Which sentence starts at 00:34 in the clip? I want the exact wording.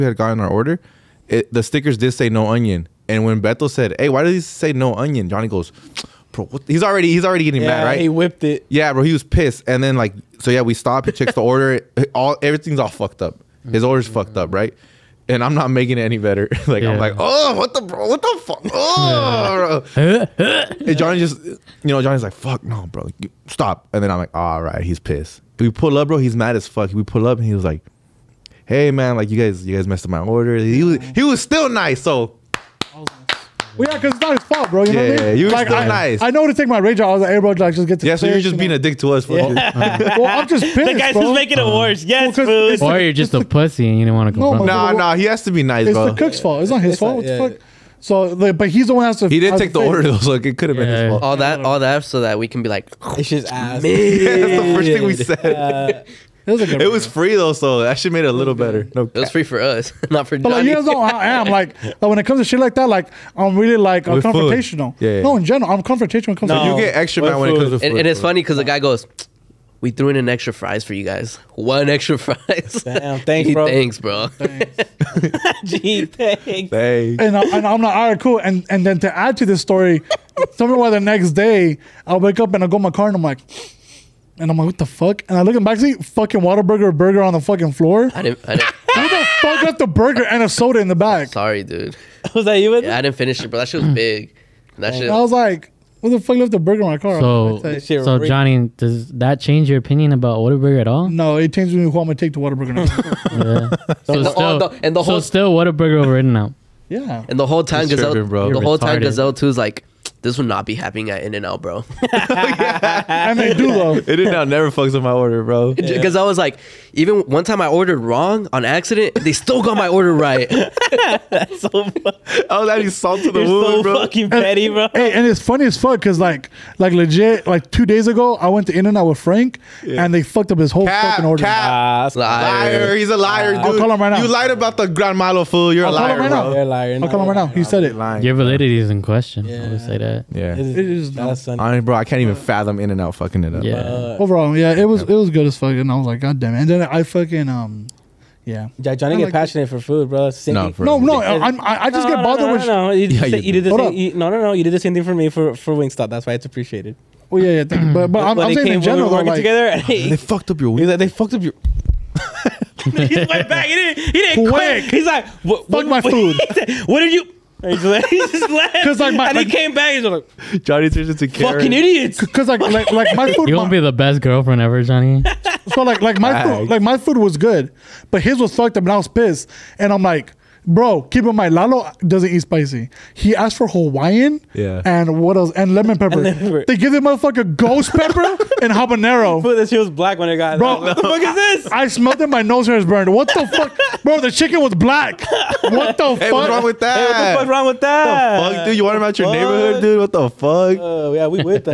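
You know what I yeah, mean?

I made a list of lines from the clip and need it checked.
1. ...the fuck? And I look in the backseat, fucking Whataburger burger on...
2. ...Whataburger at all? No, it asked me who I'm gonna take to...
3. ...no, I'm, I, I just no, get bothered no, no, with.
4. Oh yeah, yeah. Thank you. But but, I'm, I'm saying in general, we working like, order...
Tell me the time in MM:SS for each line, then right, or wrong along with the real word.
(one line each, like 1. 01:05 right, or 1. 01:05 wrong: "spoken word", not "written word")
1. 01:24 right
2. 01:40 wrong: "changed", not "asked"
3. 02:30 right
4. 02:37 wrong: "together", not "order".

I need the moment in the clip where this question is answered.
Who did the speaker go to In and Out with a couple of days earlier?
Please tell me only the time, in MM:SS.
02:09.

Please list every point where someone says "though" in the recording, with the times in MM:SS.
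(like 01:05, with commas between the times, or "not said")
00:50, 00:57, 01:53.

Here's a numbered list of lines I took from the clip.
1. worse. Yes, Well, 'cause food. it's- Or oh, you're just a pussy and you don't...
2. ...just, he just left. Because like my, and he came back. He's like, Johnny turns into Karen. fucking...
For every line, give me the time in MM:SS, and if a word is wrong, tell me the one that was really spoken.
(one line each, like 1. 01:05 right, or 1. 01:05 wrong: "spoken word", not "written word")
1. 00:41 right
2. 02:47 right.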